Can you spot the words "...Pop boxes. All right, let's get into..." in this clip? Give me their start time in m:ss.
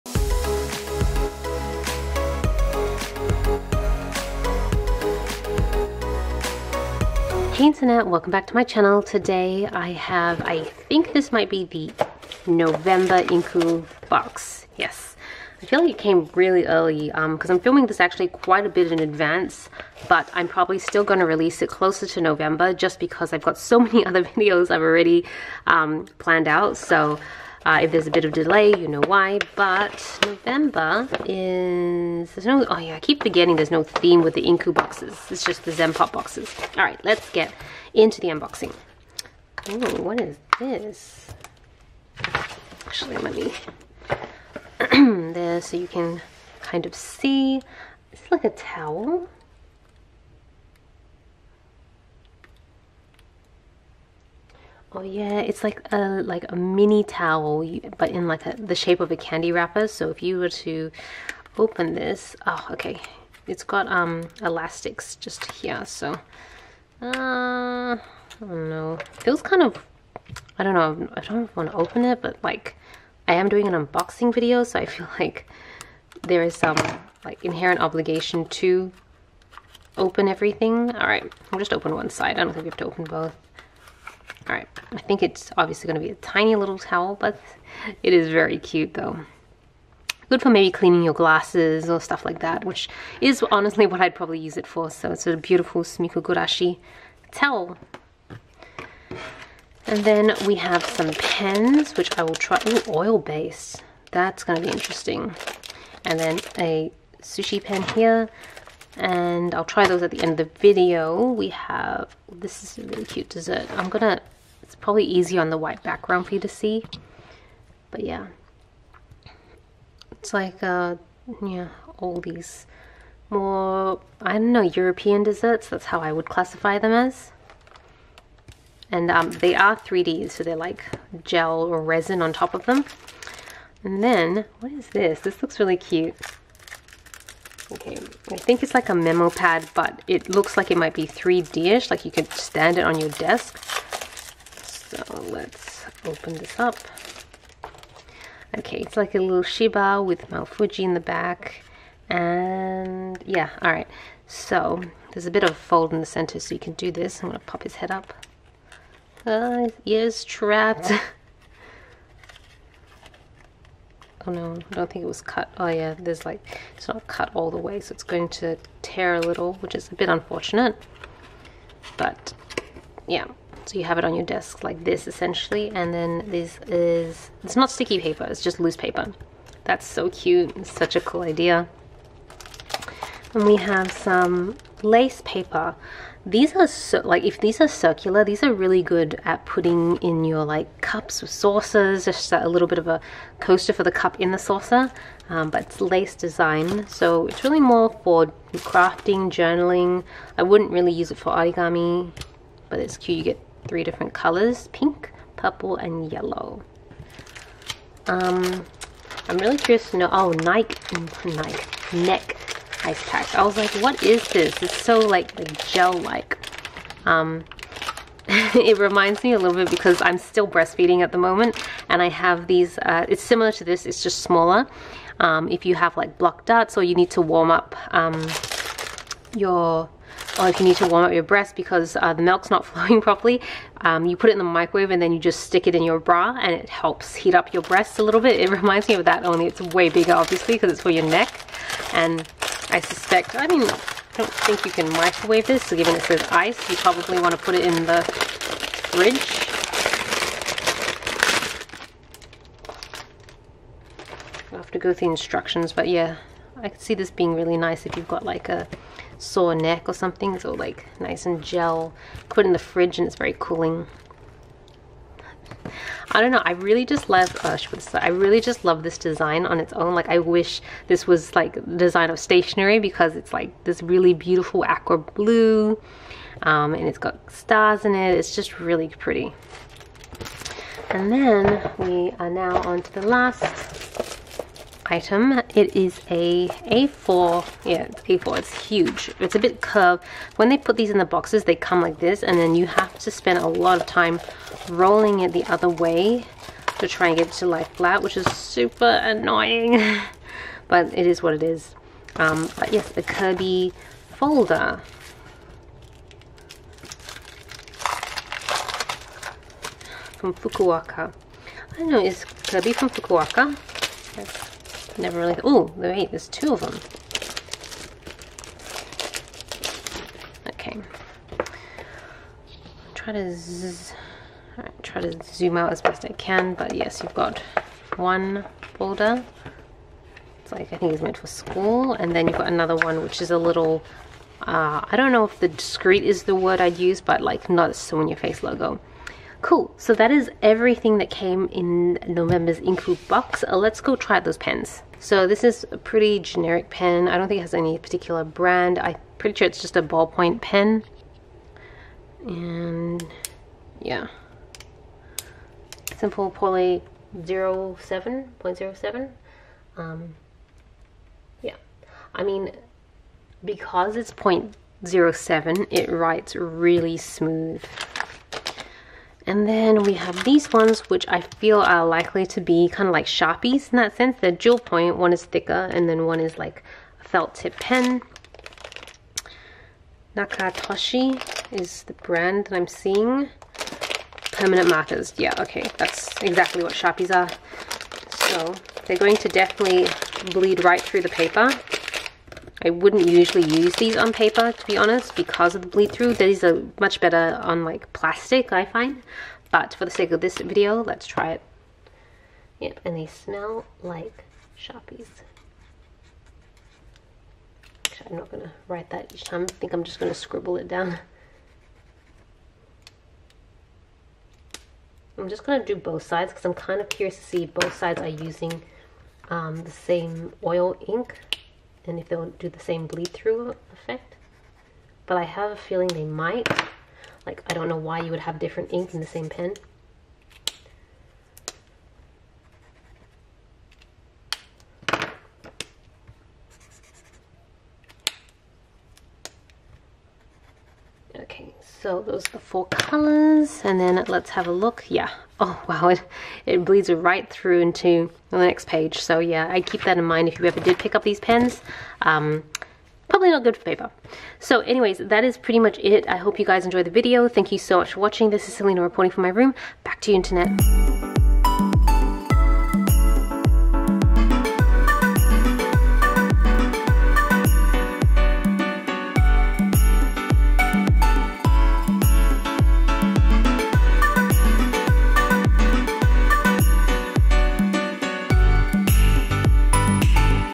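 0:35.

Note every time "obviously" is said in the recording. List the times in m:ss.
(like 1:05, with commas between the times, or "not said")
1:25, 4:00.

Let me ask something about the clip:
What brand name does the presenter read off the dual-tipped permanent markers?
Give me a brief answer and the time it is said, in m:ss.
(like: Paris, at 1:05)
Nakatoshi, at 6:20.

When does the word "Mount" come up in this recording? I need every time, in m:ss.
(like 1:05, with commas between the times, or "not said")
2:30.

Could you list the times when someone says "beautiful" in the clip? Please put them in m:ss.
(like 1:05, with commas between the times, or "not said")
1:35, 4:34.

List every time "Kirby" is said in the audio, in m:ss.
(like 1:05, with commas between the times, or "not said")
5:03, 5:12.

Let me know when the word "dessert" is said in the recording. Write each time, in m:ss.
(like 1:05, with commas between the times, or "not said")
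1:53, 2:05.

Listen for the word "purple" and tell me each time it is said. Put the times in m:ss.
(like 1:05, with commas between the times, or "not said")
3:25.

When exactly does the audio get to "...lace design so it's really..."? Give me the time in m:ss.
3:15.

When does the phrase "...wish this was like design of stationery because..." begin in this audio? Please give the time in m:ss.
4:30.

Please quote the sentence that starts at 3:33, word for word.
I was like, what is this?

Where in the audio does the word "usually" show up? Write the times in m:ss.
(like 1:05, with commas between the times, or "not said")
6:33.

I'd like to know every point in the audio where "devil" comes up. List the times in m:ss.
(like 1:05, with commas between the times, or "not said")
not said.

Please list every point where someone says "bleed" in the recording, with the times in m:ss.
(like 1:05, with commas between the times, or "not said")
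6:30, 6:35, 7:02, 7:26.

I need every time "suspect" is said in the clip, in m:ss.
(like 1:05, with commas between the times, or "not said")
4:02.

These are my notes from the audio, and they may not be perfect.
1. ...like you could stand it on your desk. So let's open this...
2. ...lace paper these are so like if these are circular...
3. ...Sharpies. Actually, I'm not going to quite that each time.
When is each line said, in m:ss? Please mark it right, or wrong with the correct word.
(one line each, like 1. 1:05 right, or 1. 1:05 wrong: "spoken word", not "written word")
1. 2:21 right
2. 3:04 right
3. 6:44 wrong: "write", not "quite".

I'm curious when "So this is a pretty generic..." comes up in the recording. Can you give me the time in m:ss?
5:44.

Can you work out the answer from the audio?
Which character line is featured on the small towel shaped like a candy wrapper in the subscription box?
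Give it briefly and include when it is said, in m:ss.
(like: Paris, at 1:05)
Sumikkogurashi, at 1:35.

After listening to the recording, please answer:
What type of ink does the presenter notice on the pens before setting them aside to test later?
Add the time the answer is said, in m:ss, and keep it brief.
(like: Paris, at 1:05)
oil base, at 1:42.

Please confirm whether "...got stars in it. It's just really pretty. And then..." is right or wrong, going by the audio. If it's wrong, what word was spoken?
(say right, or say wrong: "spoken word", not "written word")
right.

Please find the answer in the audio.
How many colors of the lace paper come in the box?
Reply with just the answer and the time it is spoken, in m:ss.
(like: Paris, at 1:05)
3, at 3:23.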